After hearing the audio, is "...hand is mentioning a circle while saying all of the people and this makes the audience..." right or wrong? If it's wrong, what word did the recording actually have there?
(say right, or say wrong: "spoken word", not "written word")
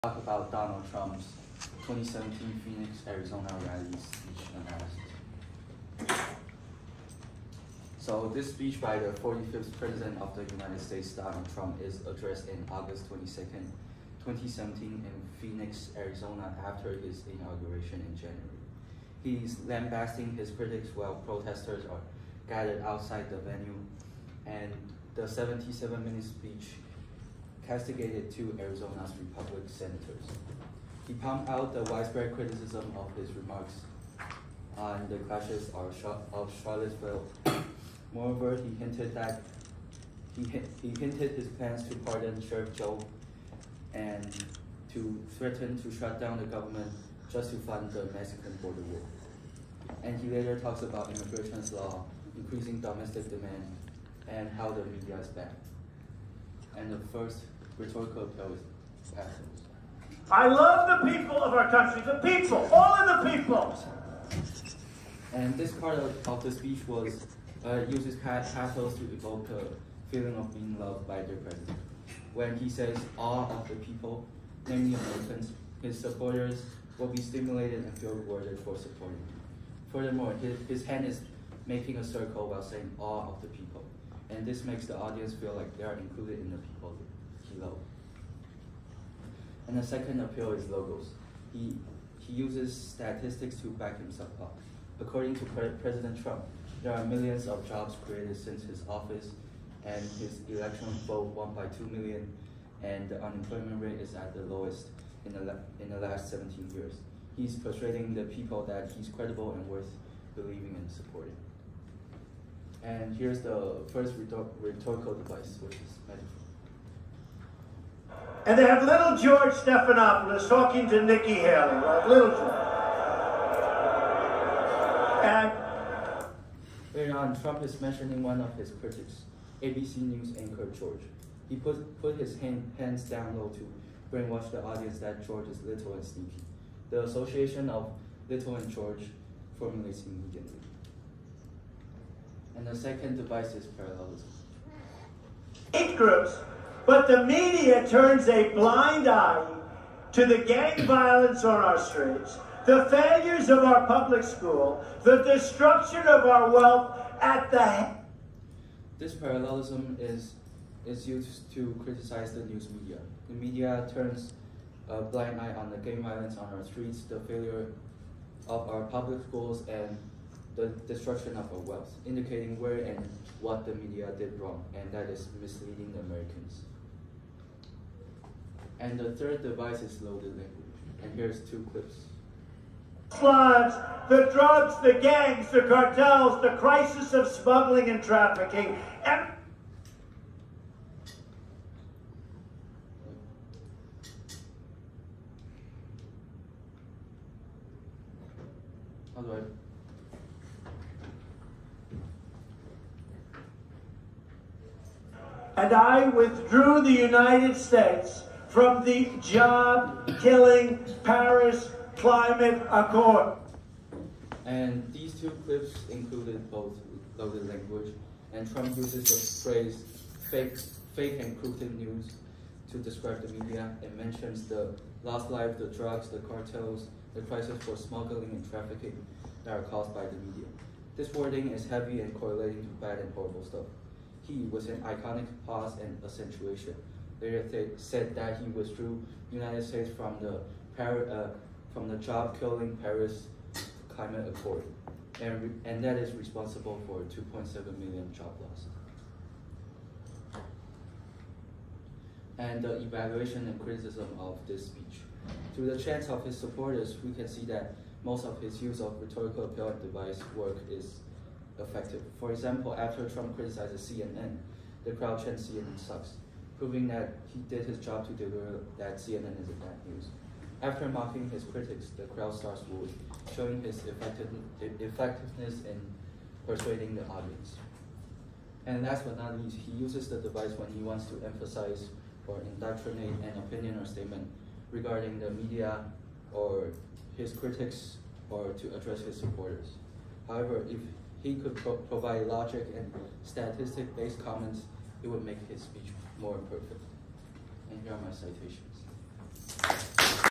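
wrong: "making", not "mentioning".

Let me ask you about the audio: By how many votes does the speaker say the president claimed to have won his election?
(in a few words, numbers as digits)
2 million.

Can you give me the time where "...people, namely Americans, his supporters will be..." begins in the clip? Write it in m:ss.
1:13.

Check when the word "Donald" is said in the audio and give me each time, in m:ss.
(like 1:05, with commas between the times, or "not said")
0:00, 0:11.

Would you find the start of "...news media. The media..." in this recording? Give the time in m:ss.
2:42.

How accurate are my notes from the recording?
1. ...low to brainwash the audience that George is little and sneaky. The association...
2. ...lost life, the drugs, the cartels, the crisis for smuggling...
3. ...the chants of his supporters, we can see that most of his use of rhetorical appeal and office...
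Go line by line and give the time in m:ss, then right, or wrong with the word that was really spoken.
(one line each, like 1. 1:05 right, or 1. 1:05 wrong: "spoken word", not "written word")
1. 2:13 right
2. 3:45 right
3. 4:15 wrong: "device", not "office".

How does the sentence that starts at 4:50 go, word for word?
However, if he could pro provide logic and statistic-based comments, it would make his speech more perfect.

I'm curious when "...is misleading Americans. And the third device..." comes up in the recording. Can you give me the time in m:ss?
2:55.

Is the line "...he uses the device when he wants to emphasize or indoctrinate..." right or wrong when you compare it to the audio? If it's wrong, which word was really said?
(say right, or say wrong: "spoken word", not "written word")
right.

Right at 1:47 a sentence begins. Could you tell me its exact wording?
He's persuading the people that he's credible and worth believing and supporting.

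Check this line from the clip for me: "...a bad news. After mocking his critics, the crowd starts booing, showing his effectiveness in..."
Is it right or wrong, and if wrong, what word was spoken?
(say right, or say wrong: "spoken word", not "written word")
right.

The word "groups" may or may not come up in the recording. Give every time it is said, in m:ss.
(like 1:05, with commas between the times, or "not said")
2:25.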